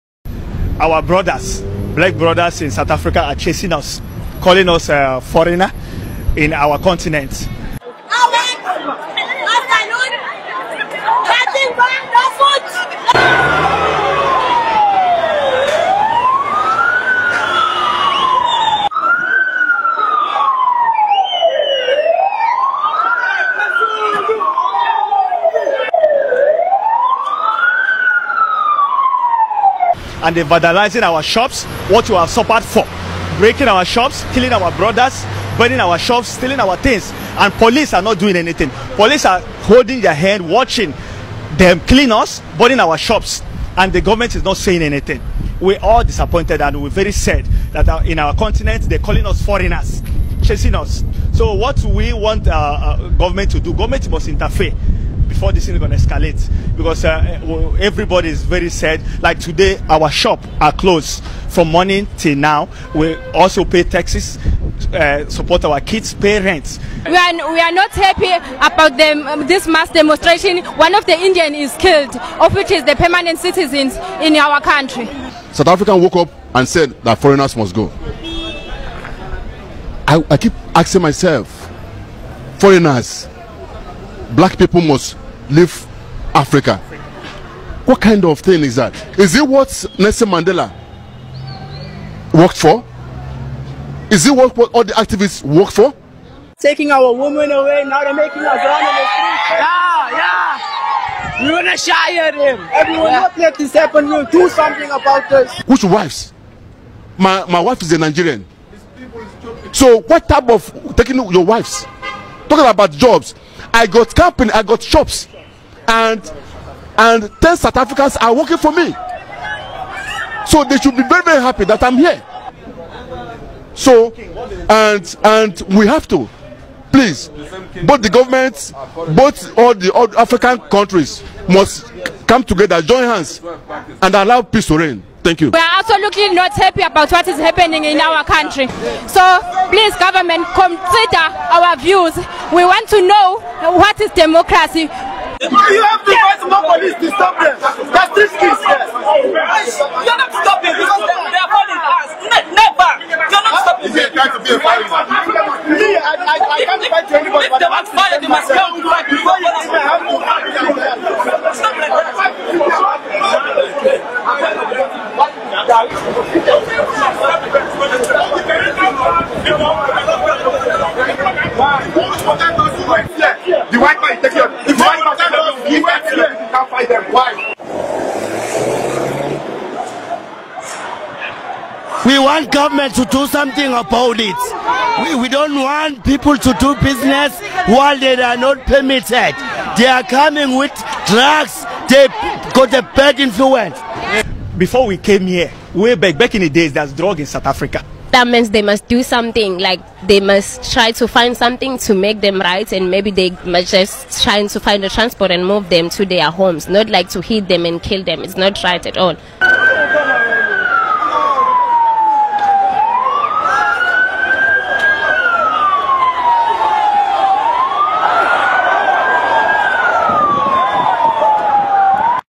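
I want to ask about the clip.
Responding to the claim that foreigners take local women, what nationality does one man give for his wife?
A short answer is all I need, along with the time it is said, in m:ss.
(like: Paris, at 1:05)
Nigerian, at 1:47.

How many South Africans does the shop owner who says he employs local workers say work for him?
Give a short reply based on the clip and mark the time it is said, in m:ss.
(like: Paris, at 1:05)
10, at 1:57.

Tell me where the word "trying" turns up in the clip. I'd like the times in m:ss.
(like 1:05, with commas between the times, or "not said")
2:34, 3:24.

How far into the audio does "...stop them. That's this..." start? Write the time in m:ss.
2:27.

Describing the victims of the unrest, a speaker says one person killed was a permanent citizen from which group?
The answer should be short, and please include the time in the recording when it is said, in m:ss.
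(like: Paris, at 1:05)
Indians, at 1:11.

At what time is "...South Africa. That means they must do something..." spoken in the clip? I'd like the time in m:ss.
3:17.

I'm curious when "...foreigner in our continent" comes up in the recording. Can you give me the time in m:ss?
0:05.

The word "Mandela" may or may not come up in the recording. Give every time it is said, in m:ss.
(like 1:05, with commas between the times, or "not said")
1:30.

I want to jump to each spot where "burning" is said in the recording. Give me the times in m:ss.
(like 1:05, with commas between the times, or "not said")
0:35, 0:42.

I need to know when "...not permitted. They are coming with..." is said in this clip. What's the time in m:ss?
3:08.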